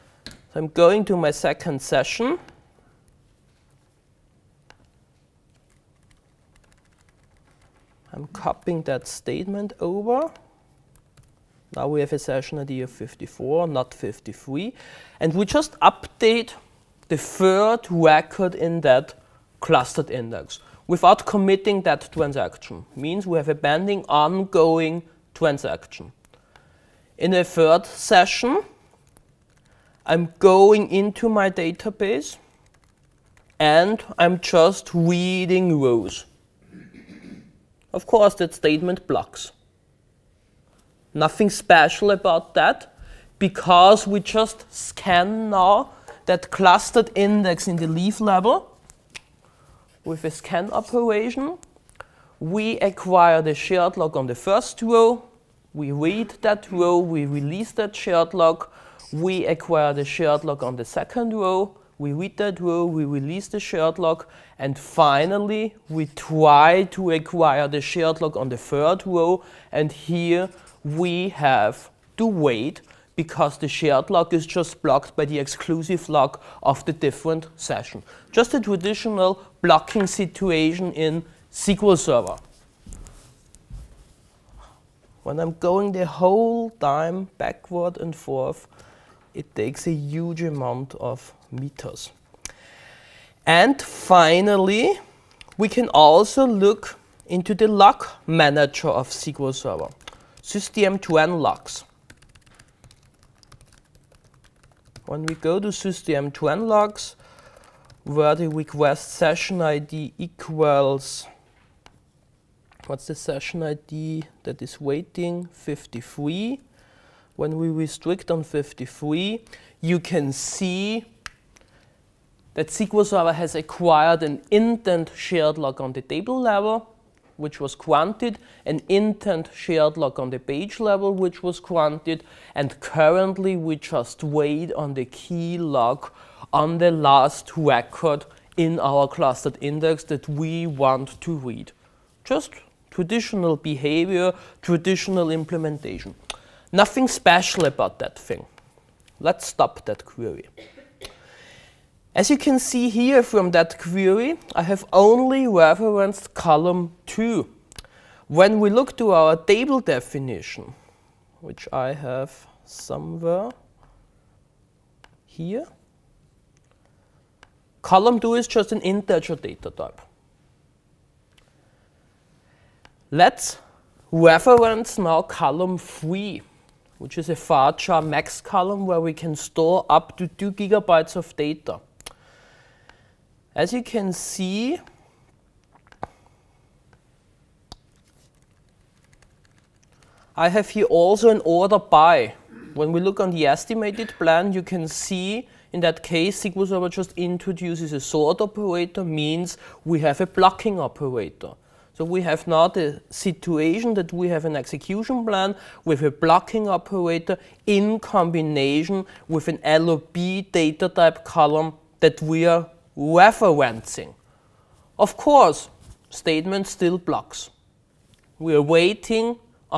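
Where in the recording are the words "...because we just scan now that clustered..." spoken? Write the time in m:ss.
0:43.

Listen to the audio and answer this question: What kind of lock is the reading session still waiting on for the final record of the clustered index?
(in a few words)
key lock.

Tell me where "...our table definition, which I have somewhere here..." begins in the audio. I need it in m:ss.
2:39.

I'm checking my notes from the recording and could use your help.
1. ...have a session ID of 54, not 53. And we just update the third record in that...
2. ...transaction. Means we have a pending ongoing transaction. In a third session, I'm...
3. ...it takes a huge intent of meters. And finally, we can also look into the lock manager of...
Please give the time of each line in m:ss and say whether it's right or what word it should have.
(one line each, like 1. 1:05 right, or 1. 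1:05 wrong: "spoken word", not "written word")
1. 0:11 right
2. 0:22 right
3. 1:29 wrong: "amount", not "intent".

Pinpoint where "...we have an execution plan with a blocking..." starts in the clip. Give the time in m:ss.
3:24.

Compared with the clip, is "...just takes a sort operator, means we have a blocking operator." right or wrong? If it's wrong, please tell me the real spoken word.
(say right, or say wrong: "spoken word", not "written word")
wrong: "introduces", not "takes".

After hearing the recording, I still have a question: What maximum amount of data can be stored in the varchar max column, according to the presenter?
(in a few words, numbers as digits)
2 gigabytes.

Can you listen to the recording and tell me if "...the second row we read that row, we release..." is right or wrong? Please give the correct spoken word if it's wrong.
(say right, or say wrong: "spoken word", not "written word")
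right.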